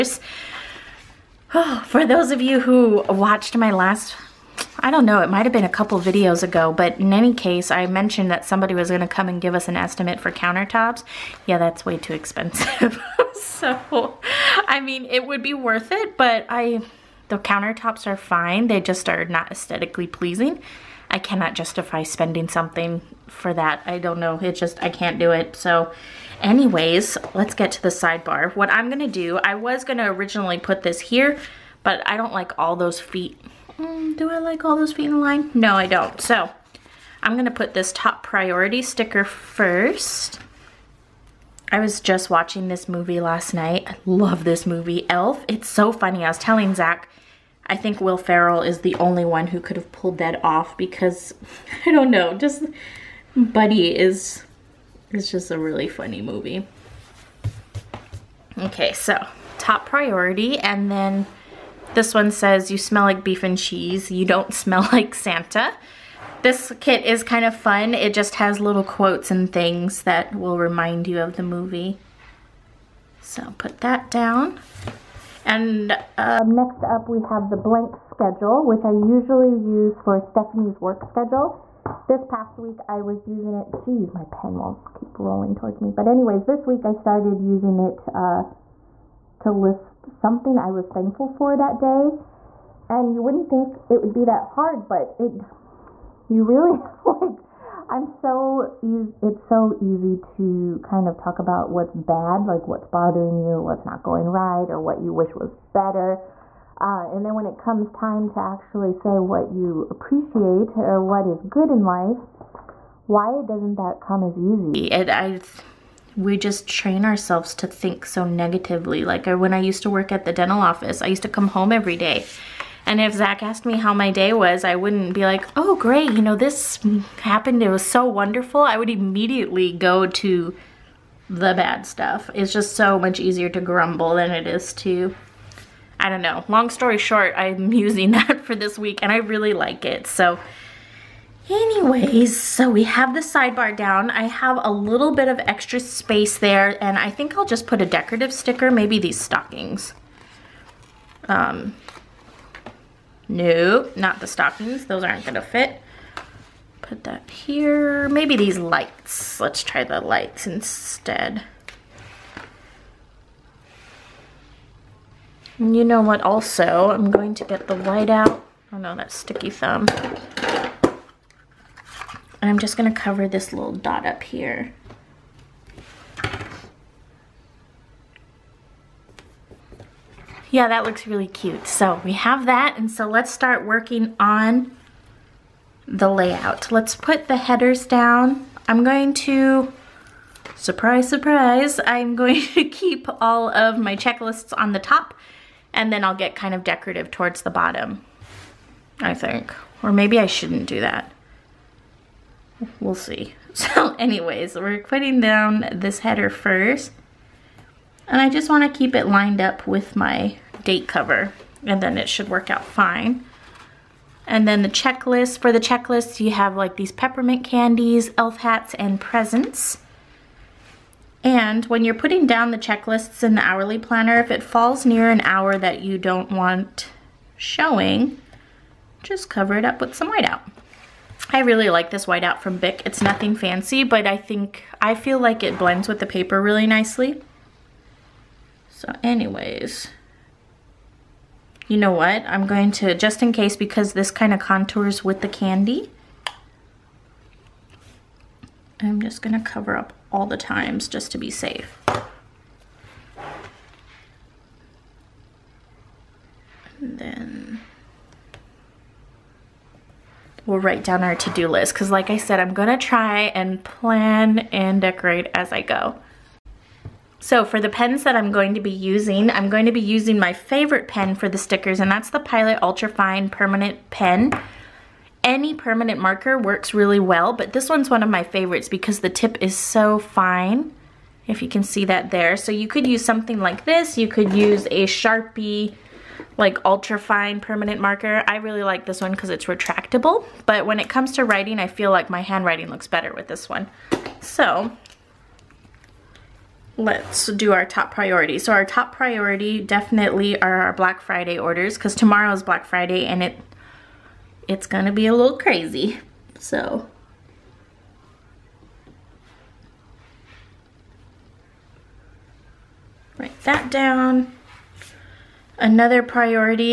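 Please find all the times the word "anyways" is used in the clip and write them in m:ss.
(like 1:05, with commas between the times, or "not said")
0:26, 1:26, 2:21, 3:23, 3:59.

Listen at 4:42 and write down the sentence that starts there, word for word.
So you could use something like this, you could use a Sharpie, like ultra fine permanent marker.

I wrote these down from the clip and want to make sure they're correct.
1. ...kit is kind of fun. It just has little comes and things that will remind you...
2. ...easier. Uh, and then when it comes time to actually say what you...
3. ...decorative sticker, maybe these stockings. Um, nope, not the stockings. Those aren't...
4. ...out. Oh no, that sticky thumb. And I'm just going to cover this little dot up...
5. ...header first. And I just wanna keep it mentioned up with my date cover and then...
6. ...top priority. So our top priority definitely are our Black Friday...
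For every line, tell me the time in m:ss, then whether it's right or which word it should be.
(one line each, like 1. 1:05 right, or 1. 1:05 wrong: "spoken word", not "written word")
1. 1:06 wrong: "quotes", not "comes"
2. 1:45 wrong: "better", not "easier"
3. 2:27 right
4. 2:48 right
5. 3:25 wrong: "lined", not "mentioned"
6. 4:57 right.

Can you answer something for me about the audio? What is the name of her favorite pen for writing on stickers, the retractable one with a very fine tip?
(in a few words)
Pilot Ultra Fine Permanent Pen.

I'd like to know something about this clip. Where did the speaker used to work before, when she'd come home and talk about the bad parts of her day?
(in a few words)
dental office.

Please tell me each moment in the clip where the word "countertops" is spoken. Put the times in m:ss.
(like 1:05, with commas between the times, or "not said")
0:10, 0:17.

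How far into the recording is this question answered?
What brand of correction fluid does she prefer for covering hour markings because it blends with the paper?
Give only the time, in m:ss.
3:52.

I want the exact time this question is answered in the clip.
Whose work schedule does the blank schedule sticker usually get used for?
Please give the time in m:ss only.
1:20.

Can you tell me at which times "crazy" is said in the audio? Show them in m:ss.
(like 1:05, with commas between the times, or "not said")
5:05.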